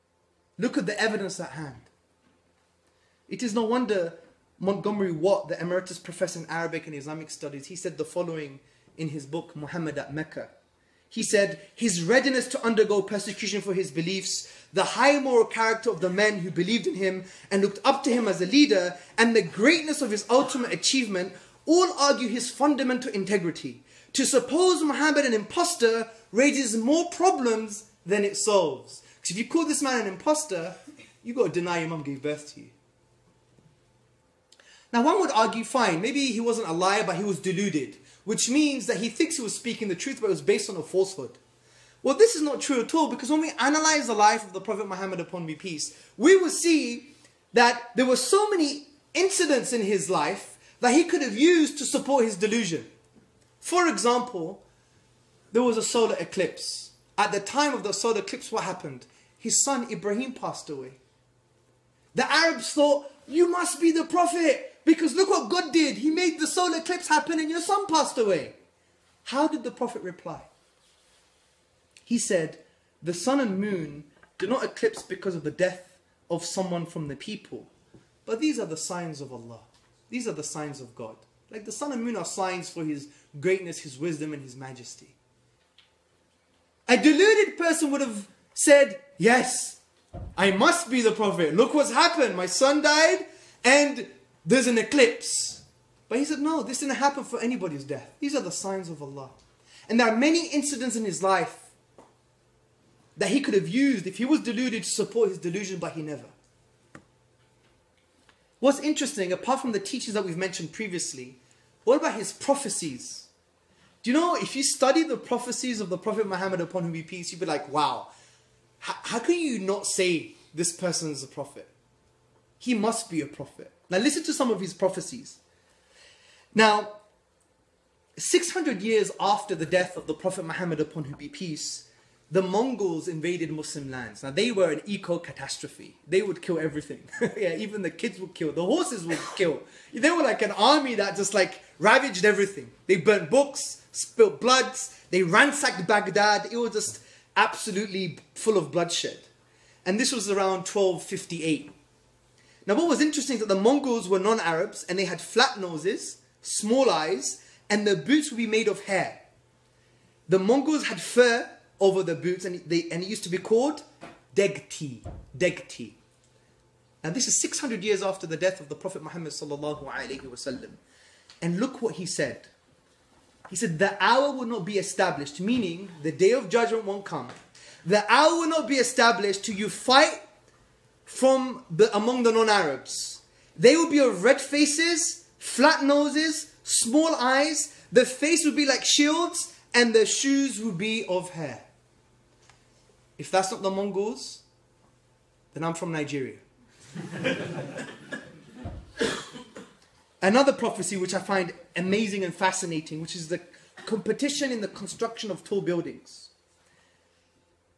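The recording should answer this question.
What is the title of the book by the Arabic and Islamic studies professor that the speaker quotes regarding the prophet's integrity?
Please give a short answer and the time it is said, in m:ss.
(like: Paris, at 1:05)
Muhammad at Mecca, at 0:09.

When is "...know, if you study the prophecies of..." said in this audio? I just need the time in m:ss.
1:54.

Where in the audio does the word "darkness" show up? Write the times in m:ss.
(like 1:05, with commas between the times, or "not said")
not said.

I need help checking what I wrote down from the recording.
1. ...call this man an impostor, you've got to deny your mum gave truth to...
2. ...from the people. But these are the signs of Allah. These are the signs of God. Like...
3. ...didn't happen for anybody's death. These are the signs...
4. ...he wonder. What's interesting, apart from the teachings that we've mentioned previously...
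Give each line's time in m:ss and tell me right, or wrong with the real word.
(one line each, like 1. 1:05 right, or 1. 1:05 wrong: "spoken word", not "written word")
1. 0:29 wrong: "birth", not "truth"
2. 1:16 right
3. 1:36 right
4. 1:45 wrong: "never", not "wonder".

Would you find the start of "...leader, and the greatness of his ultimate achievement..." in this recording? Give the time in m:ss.
0:18.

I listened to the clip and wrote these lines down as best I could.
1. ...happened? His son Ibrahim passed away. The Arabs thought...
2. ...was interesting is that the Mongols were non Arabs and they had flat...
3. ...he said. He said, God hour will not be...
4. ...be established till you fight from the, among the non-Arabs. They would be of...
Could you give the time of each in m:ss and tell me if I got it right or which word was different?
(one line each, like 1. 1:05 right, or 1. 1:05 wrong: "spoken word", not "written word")
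1. 0:58 right
2. 2:32 right
3. 2:51 wrong: "The", not "God"
4. 2:58 right.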